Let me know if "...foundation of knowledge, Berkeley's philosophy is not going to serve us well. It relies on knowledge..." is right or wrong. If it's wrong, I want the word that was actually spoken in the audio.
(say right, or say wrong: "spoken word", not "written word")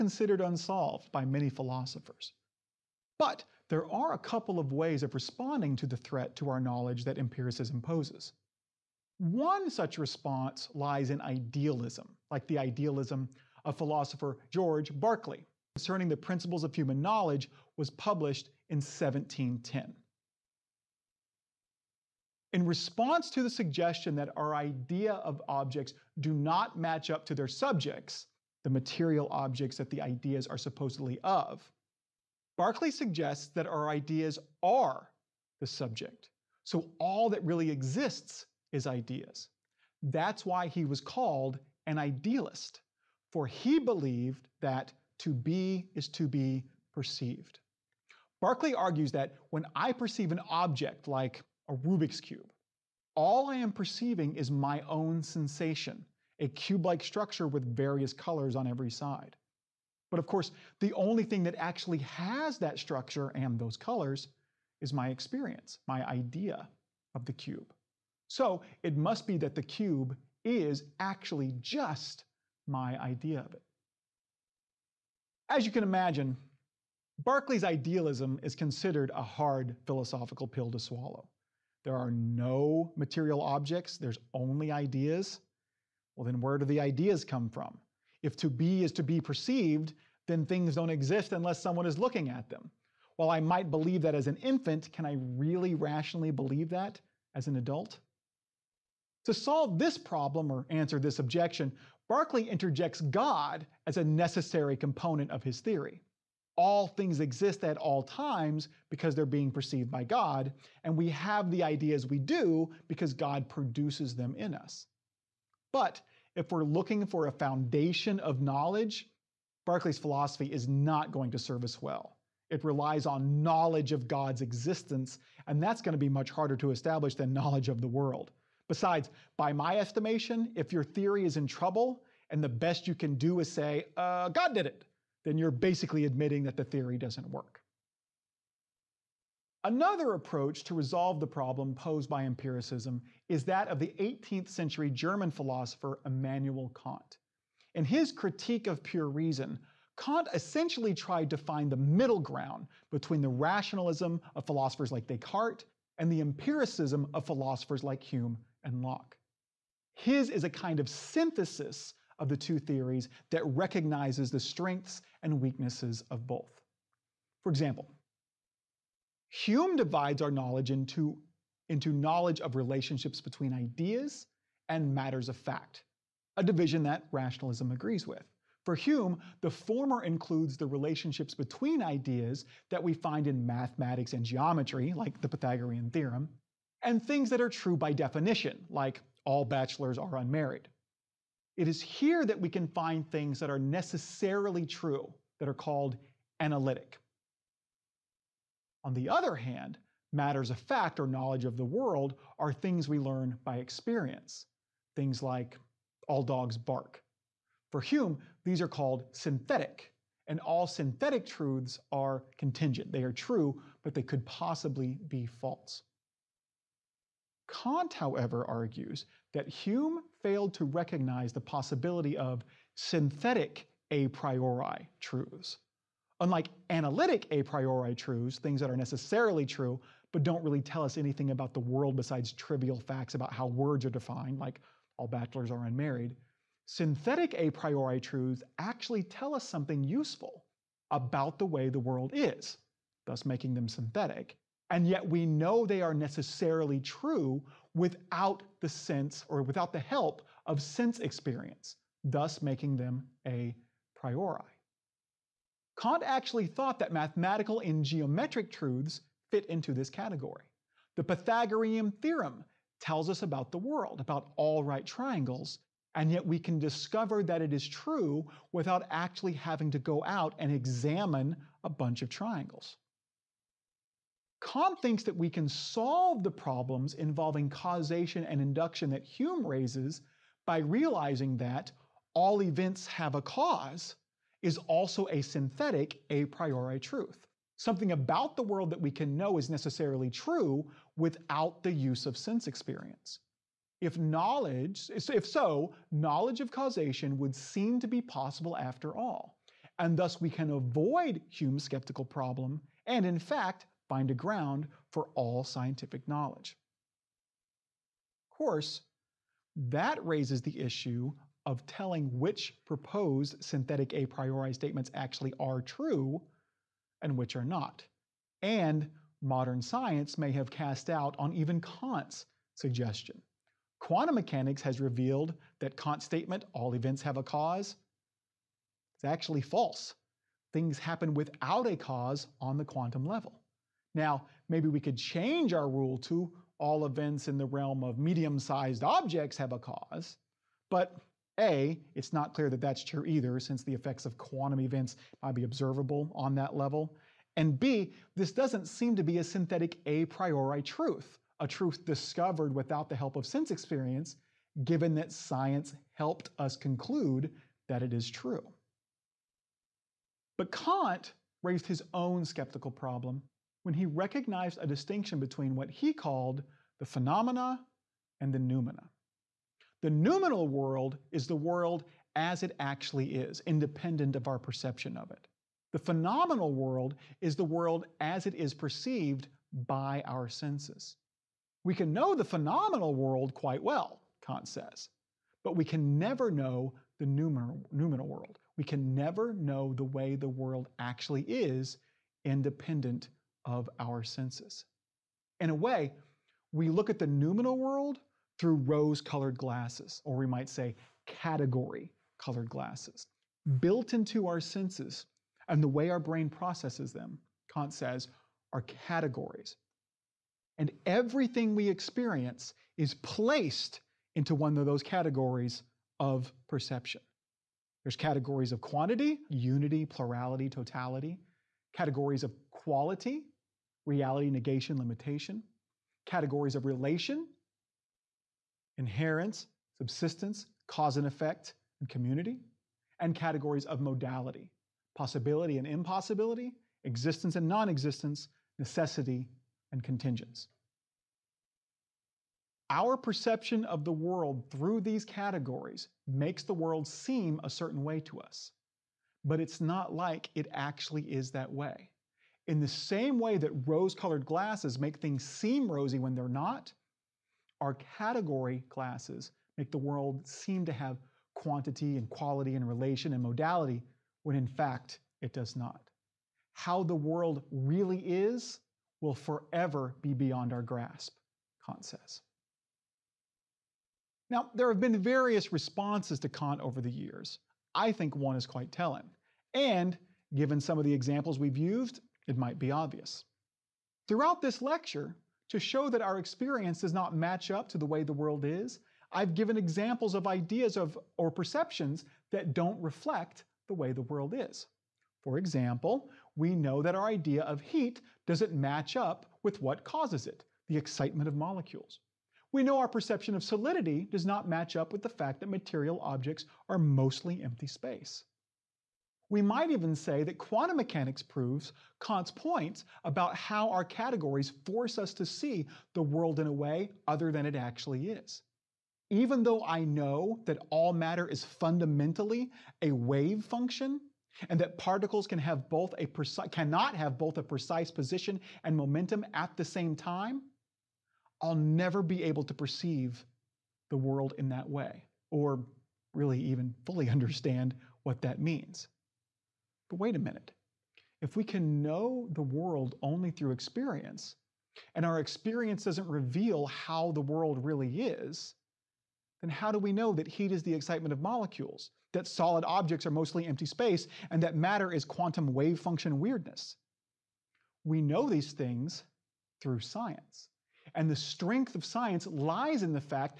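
right.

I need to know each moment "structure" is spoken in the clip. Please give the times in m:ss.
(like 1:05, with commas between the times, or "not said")
0:57, 1:02.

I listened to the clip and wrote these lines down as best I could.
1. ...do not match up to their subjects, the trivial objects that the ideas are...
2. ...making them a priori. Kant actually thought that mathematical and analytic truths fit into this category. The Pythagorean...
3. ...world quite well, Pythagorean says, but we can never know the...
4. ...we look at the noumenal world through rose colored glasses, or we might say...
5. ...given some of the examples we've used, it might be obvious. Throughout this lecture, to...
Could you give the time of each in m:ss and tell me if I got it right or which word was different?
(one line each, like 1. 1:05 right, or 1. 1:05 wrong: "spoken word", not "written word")
1. 0:26 wrong: "material", not "trivial"
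2. 4:12 wrong: "geometric", not "analytic"
3. 6:22 wrong: "Kant", not "Pythagorean"
4. 6:36 right
5. 8:00 right.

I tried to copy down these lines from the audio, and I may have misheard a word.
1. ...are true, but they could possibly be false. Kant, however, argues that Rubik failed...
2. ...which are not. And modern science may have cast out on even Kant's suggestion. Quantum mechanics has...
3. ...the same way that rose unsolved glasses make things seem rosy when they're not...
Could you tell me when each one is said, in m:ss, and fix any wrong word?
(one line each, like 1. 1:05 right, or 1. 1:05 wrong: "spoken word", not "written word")
1. 3:33 wrong: "Hume", not "Rubik"
2. 5:17 right
3. 7:32 wrong: "colored", not "unsolved".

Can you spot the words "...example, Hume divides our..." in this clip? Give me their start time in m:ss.
2:47.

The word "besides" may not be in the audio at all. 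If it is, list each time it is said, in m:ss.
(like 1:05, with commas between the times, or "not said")
2:08, 3:51.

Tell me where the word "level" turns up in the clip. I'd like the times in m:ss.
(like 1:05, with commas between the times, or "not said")
5:33, 5:46.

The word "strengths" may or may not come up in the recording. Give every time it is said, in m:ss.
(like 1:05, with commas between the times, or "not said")
2:44, 9:21.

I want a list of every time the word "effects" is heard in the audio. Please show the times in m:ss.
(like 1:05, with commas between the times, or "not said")
5:43, 7:11.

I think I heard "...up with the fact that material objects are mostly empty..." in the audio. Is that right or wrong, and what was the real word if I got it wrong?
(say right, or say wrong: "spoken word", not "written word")
right.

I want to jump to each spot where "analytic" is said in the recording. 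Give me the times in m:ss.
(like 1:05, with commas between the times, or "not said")
3:16, 3:46.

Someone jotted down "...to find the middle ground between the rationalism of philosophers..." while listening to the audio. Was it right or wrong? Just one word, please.
right.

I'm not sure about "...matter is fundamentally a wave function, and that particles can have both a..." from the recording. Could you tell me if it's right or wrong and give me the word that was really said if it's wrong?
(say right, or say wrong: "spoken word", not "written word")
right.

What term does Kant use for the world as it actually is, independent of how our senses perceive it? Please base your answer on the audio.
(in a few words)
Noumena.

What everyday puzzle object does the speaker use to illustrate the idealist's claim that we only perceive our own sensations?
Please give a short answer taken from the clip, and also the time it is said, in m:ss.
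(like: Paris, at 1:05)
Rubik's Cube, at 0:51.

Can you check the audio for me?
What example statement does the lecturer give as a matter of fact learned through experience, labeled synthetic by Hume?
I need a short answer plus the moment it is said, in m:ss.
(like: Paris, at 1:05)
All dogs bark, at 3:26.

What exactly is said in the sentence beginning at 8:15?
For example, we know that our idea of heat doesn't match up with what causes it, the excitement of molecules.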